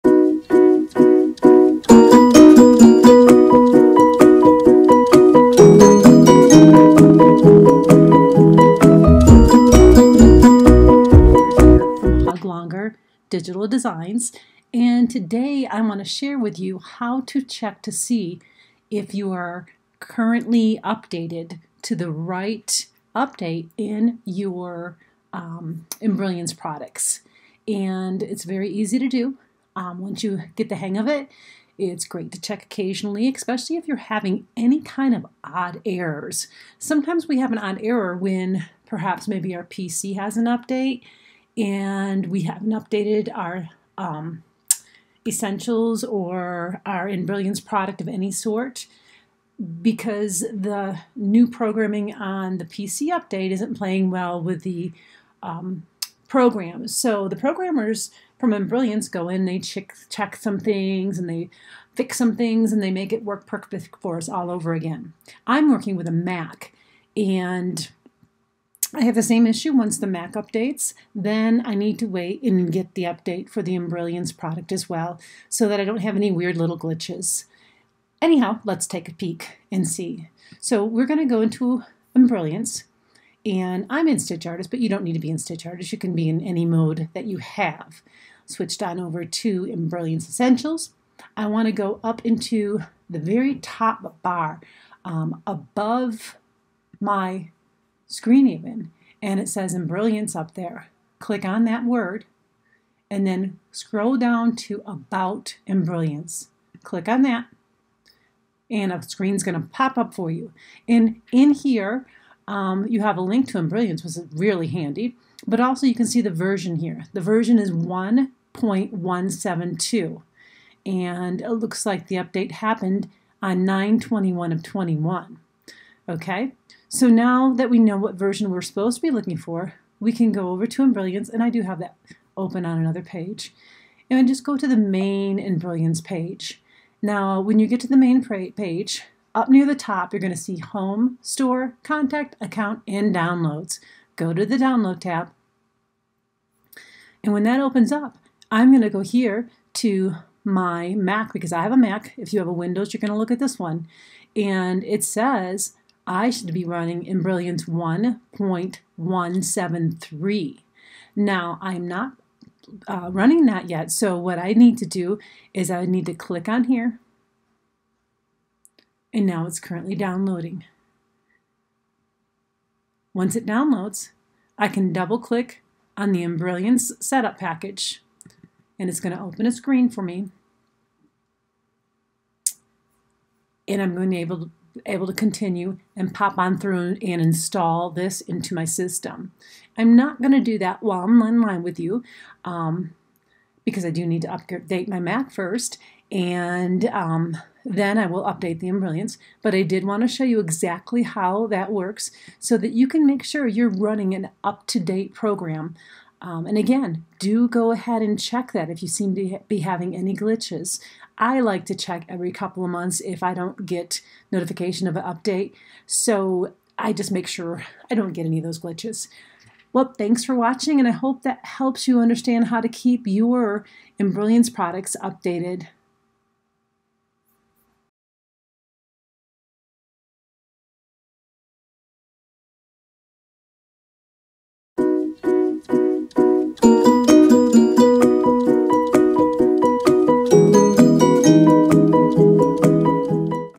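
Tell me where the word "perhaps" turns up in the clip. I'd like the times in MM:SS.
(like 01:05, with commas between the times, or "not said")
00:38.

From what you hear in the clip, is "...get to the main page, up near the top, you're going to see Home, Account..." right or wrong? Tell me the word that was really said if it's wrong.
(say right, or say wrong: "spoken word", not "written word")
wrong: "Store", not "Account".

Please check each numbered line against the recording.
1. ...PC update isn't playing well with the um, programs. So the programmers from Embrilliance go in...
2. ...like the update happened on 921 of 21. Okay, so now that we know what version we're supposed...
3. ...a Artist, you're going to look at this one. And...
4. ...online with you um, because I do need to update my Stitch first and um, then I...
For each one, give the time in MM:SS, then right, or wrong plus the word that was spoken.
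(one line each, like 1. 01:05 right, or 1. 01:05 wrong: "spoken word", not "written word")
1. 00:52 right
2. 02:01 right
3. 02:32 wrong: "Windows", not "Artist"
4. 03:11 wrong: "Mac", not "Stitch".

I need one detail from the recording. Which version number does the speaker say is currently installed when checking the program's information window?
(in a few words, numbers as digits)
1.172.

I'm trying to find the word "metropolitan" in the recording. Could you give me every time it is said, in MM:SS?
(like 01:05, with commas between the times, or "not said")
not said.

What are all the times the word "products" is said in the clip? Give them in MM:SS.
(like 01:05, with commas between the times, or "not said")
00:26, 00:47, 01:14, 03:44.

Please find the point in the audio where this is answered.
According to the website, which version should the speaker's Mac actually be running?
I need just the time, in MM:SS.
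02:37.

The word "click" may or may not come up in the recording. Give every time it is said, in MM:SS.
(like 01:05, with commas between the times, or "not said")
01:41, 01:46, 02:46, 02:55.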